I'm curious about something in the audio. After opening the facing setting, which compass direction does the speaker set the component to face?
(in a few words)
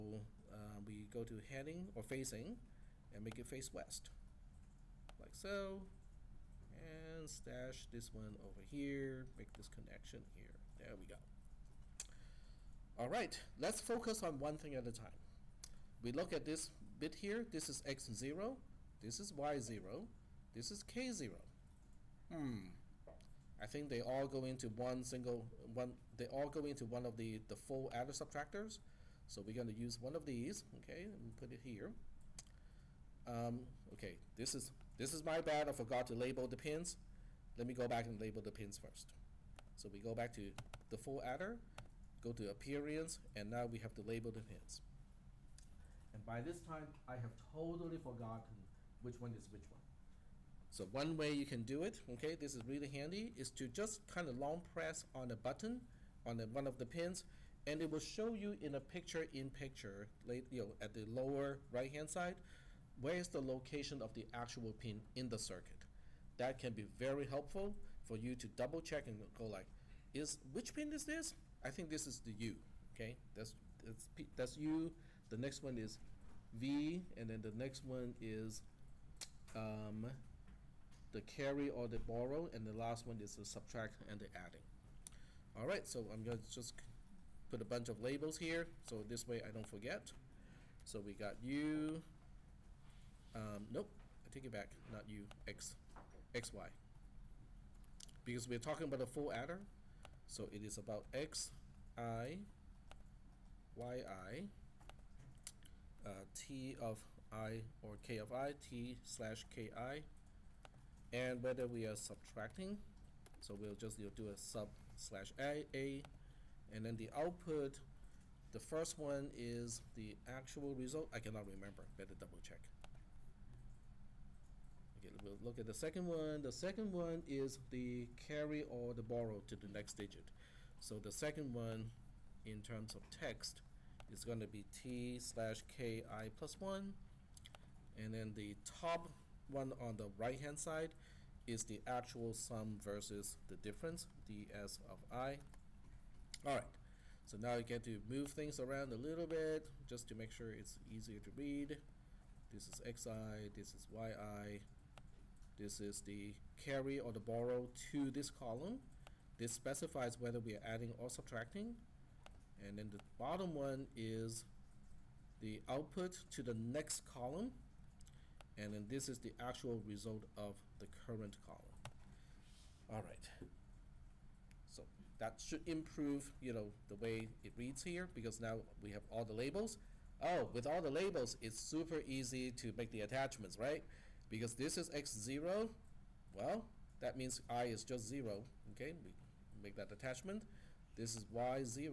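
West.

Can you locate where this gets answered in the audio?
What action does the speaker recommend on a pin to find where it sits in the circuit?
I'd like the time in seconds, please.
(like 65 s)
54 s.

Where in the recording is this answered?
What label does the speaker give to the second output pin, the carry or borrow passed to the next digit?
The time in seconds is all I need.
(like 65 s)
134 s.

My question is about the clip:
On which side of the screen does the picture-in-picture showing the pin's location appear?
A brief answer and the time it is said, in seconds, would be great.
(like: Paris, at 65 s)
Lower right, at 61 s.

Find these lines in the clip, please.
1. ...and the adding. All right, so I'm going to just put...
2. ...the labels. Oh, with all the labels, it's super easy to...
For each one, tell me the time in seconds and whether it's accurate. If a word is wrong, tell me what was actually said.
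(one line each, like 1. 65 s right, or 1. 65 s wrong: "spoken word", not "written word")
1. 84 s right
2. 179 s right.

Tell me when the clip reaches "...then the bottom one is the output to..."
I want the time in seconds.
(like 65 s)
162 s.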